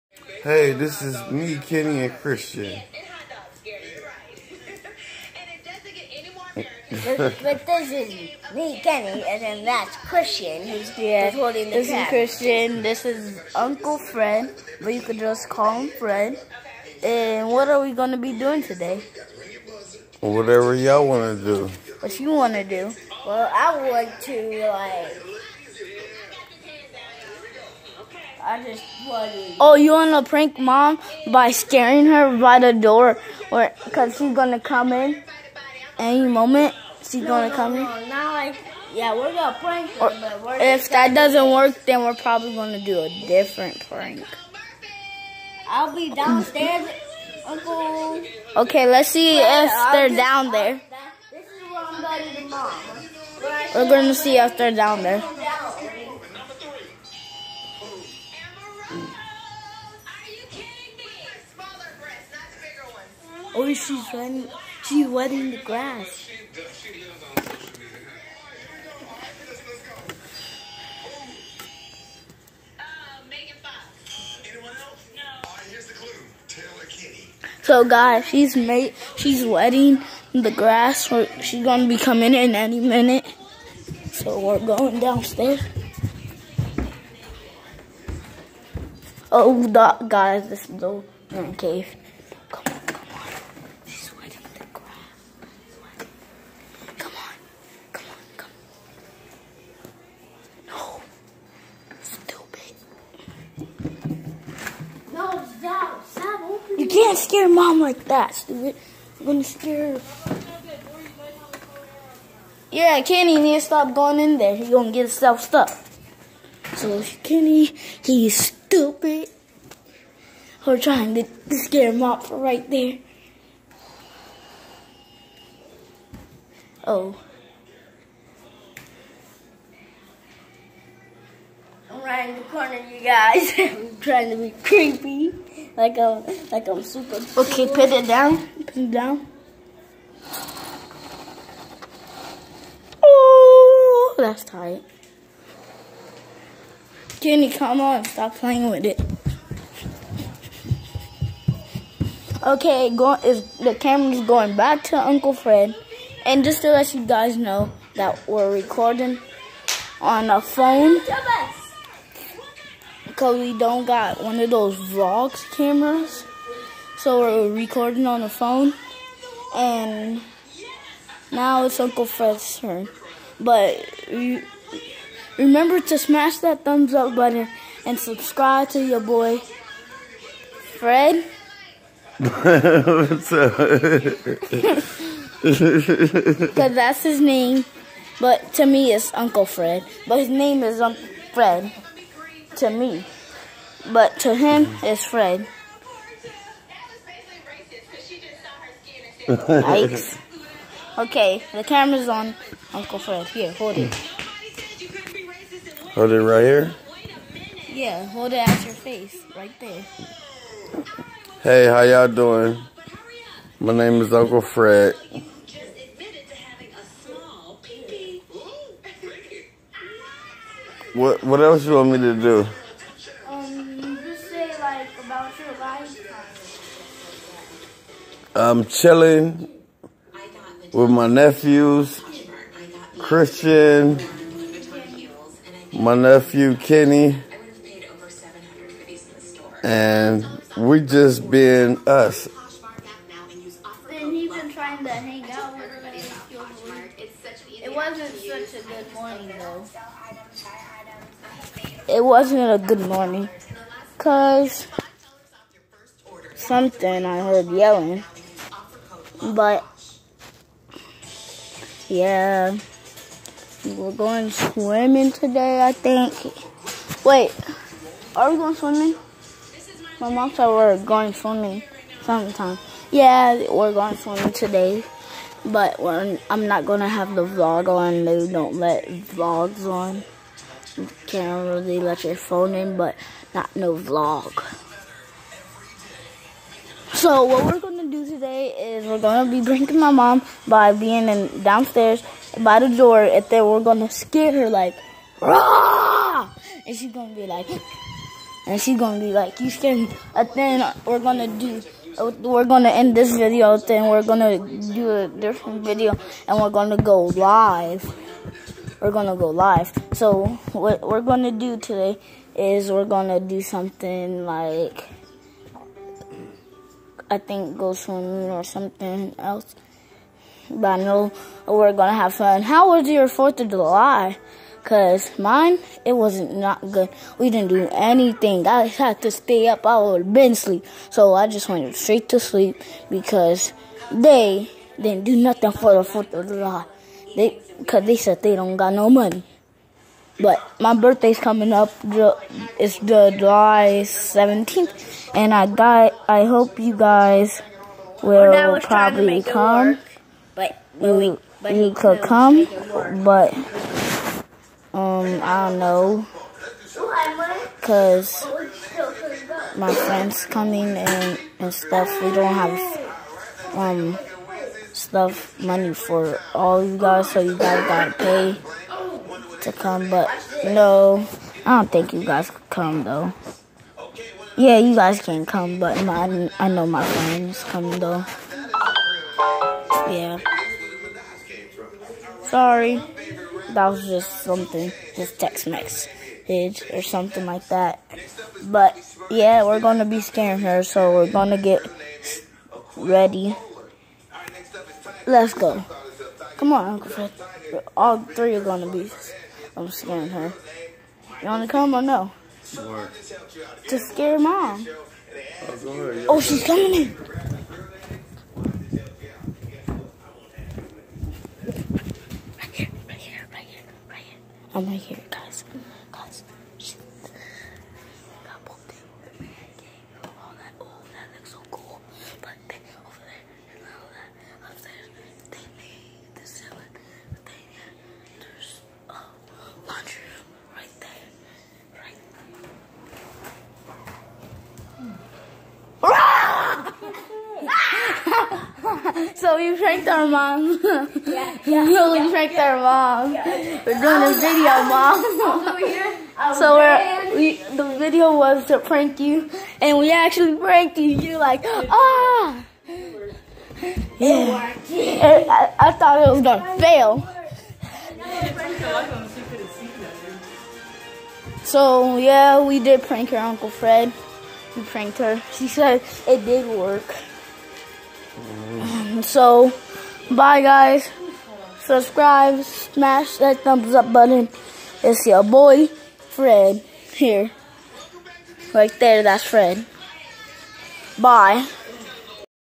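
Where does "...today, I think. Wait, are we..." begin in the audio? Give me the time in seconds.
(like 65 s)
265 s.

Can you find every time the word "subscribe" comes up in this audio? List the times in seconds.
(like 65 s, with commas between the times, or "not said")
177 s, 471 s.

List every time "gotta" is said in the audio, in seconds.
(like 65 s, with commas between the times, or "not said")
367 s.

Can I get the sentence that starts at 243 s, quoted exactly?
Then you've been trying to hang out with everybody.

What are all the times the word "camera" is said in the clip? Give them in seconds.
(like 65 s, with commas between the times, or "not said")
153 s, 165 s, 201 s.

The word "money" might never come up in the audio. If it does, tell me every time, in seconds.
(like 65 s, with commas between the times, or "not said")
338 s, 365 s.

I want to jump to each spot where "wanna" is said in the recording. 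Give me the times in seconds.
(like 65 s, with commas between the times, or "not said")
29 s, 401 s.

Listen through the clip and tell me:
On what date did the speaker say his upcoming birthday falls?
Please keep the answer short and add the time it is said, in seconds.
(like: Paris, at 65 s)
July 17, at 343 s.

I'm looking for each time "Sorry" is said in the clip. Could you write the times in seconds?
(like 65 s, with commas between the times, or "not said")
382 s.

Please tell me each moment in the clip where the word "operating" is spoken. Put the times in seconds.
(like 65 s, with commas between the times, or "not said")
not said.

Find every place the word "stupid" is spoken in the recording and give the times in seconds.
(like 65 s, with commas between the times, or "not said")
108 s, 118 s.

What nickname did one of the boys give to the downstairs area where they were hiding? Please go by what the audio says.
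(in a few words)
The cave.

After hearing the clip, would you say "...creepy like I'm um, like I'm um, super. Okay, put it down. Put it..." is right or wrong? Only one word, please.
right.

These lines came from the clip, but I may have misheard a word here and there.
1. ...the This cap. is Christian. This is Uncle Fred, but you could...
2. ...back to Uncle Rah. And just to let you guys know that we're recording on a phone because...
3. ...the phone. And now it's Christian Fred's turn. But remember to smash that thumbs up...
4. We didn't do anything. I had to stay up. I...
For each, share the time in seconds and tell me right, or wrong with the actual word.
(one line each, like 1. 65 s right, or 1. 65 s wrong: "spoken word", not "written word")
1. 11 s right
2. 154 s wrong: "Fred", not "Rah"
3. 168 s wrong: "Uncle", not "Christian"
4. 327 s right.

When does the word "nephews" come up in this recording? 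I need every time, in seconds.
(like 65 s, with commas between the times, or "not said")
231 s, 235 s.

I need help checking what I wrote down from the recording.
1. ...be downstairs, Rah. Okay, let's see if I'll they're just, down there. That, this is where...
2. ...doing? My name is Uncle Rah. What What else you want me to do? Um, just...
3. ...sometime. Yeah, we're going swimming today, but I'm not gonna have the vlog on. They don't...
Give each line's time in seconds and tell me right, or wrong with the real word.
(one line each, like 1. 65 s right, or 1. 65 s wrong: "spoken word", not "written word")
1. 45 s wrong: "Uncle", not "Rah"
2. 212 s wrong: "Fred", not "Rah"
3. 272 s right.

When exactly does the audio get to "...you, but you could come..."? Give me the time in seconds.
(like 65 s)
350 s.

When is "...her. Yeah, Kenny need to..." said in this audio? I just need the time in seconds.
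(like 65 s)
109 s.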